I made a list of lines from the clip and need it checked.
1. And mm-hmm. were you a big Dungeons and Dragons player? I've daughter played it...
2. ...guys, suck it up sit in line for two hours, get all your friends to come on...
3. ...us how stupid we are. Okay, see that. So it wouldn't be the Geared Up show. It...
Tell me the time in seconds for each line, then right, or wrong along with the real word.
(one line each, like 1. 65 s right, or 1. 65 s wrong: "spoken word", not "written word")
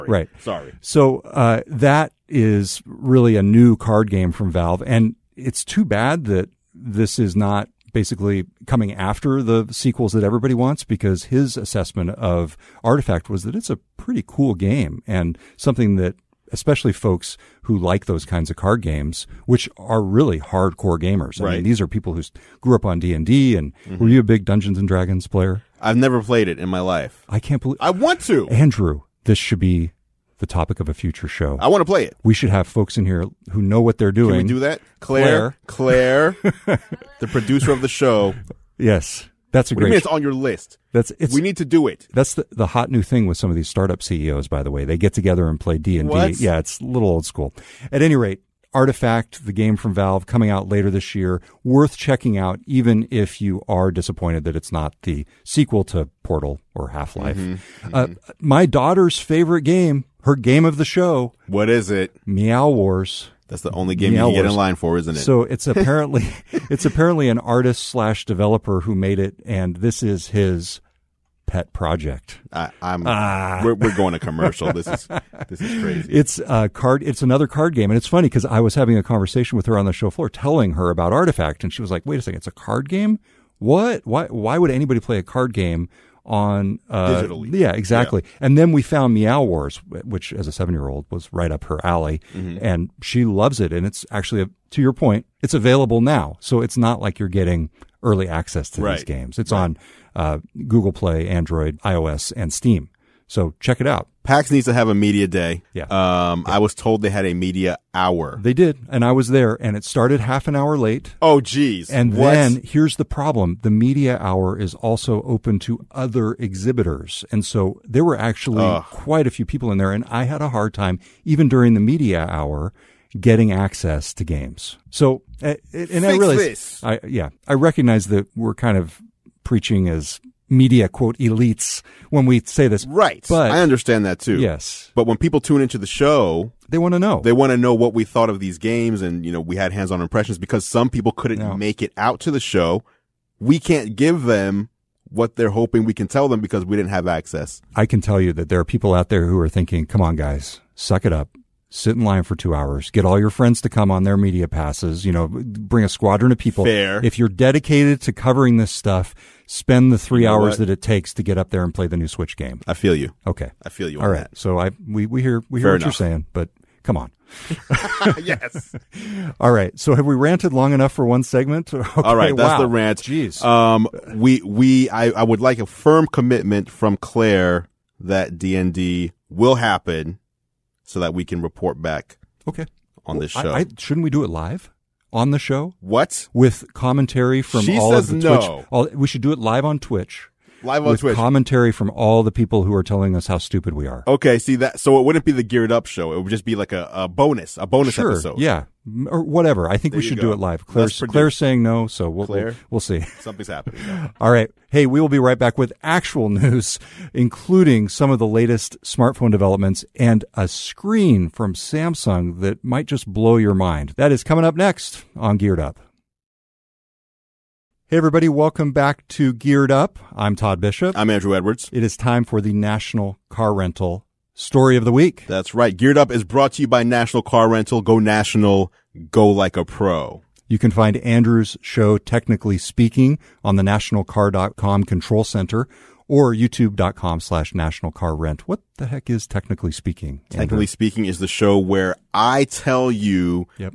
1. 23 s wrong: "never", not "daughter"
2. 150 s right
3. 193 s right.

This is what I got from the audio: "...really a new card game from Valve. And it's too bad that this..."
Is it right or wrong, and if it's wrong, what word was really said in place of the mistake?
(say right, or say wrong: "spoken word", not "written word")
right.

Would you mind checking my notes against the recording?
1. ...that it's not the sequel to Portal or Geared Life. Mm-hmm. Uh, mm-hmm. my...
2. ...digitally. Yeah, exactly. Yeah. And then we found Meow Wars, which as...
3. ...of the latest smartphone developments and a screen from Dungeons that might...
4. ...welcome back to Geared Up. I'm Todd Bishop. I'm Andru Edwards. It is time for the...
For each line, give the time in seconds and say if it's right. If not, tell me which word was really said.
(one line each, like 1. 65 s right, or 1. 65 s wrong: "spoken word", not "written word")
1. 54 s wrong: "Half", not "Geared"
2. 87 s right
3. 208 s wrong: "Samsung", not "Dungeons"
4. 218 s right.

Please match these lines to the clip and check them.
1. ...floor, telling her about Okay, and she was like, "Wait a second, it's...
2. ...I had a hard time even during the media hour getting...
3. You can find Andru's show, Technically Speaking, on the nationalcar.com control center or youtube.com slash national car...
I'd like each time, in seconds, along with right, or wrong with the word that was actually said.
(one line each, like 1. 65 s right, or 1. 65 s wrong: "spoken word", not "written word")
1. 80 s wrong: "Artifact", not "Okay"
2. 120 s right
3. 230 s right.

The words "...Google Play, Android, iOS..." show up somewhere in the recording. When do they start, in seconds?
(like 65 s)
100 s.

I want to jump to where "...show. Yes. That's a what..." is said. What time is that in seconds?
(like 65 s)
37 s.